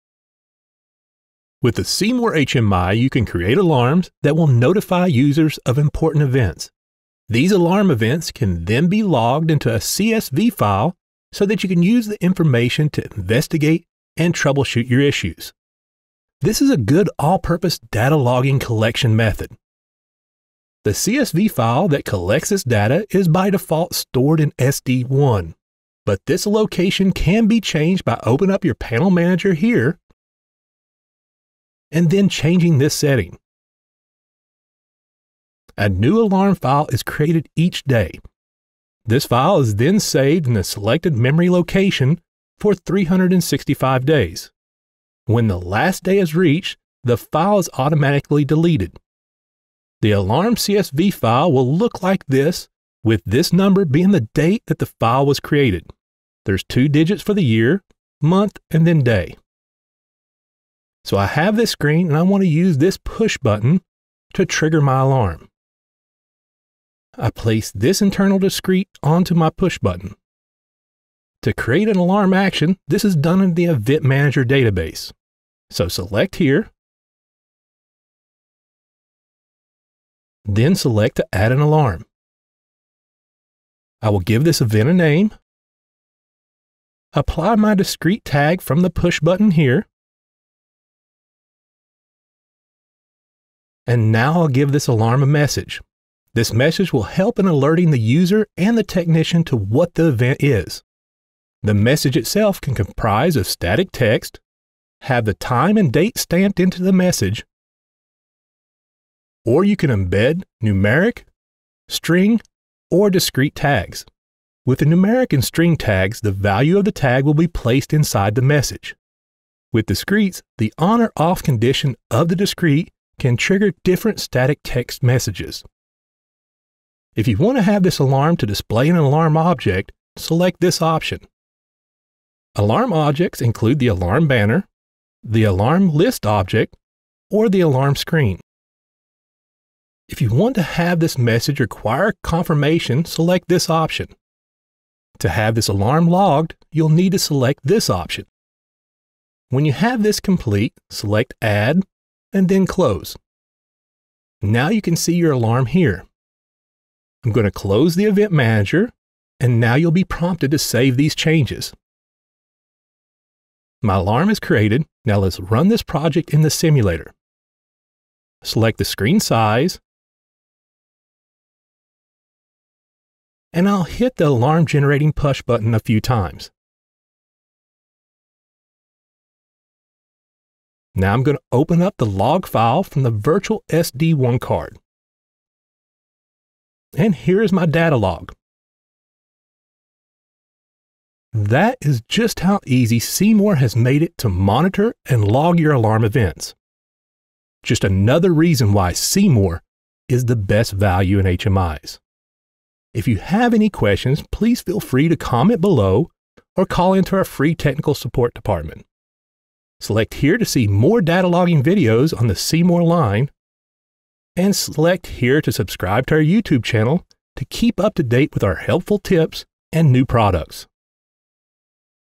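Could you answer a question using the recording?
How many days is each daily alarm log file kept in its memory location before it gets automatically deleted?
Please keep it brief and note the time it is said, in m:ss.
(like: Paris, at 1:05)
365, at 0:42.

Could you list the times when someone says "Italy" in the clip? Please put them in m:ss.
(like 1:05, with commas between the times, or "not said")
not said.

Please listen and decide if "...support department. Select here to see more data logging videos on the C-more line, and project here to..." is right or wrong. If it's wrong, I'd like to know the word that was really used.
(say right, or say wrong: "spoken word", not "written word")
wrong: "select", not "project".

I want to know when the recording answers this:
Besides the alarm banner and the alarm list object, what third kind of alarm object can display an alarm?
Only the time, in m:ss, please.
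2:17.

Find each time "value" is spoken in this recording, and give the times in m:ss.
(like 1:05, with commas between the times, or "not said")
1:56, 3:20.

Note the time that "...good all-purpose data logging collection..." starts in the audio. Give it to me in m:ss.
0:16.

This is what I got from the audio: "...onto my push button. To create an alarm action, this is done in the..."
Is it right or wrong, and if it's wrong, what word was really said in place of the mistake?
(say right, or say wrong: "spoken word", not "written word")
right.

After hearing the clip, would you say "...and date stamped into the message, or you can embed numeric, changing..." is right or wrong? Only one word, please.
wrong.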